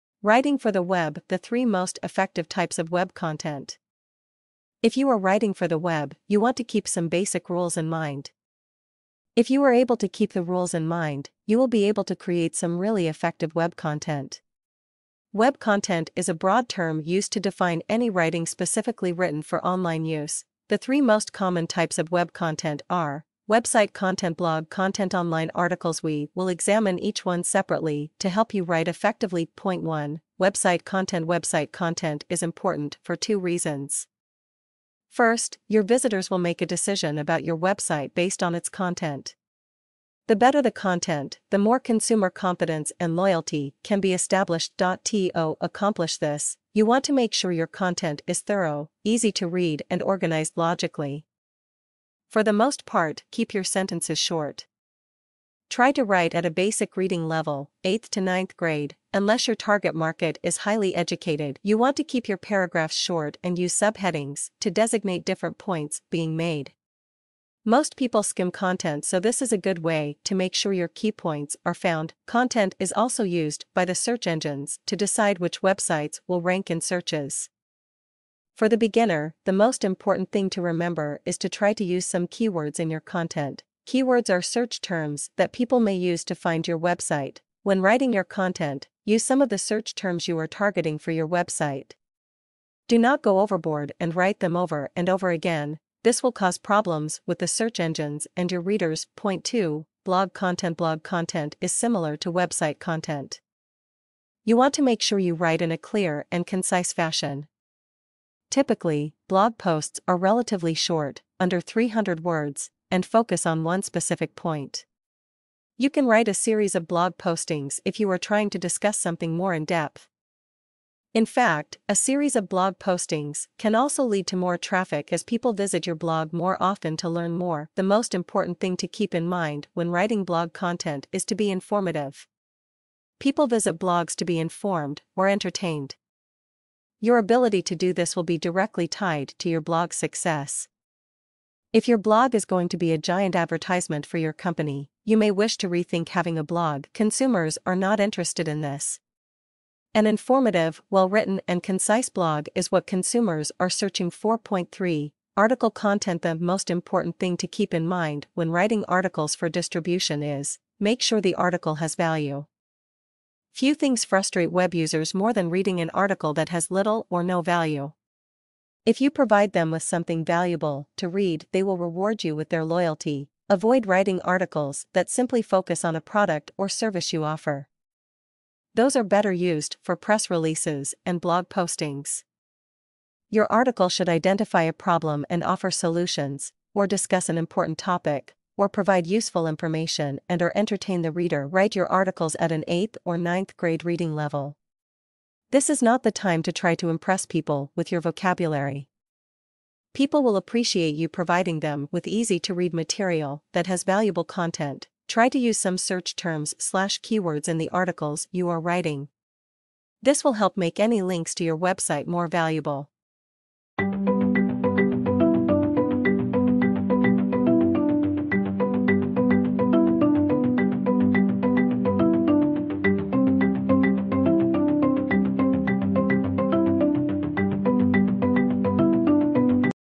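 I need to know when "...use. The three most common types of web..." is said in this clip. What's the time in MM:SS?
00:20.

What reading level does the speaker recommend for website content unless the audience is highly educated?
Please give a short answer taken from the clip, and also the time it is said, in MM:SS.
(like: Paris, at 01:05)
8th to 9th grade, at 00:57.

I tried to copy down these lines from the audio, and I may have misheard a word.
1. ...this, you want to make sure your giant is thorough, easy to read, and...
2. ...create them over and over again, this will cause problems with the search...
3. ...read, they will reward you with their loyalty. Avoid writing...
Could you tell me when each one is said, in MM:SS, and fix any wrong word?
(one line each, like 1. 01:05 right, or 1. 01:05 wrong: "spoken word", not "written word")
1. 00:46 wrong: "content", not "giant"
2. 01:34 wrong: "write", not "create"
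3. 02:51 right.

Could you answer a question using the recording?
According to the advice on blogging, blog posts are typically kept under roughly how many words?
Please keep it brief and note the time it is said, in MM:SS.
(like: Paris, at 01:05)
300, at 01:51.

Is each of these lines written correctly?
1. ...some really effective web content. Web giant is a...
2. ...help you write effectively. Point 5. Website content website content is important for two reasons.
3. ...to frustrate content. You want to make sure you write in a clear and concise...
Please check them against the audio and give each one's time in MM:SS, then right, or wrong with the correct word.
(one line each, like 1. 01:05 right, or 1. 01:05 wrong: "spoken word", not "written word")
1. 00:12 wrong: "content", not "giant"
2. 00:28 wrong: "1", not "5"
3. 01:42 wrong: "website", not "frustrate".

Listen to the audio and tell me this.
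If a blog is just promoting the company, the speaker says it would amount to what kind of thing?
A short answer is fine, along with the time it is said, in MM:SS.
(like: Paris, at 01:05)
giant advertisement, at 02:22.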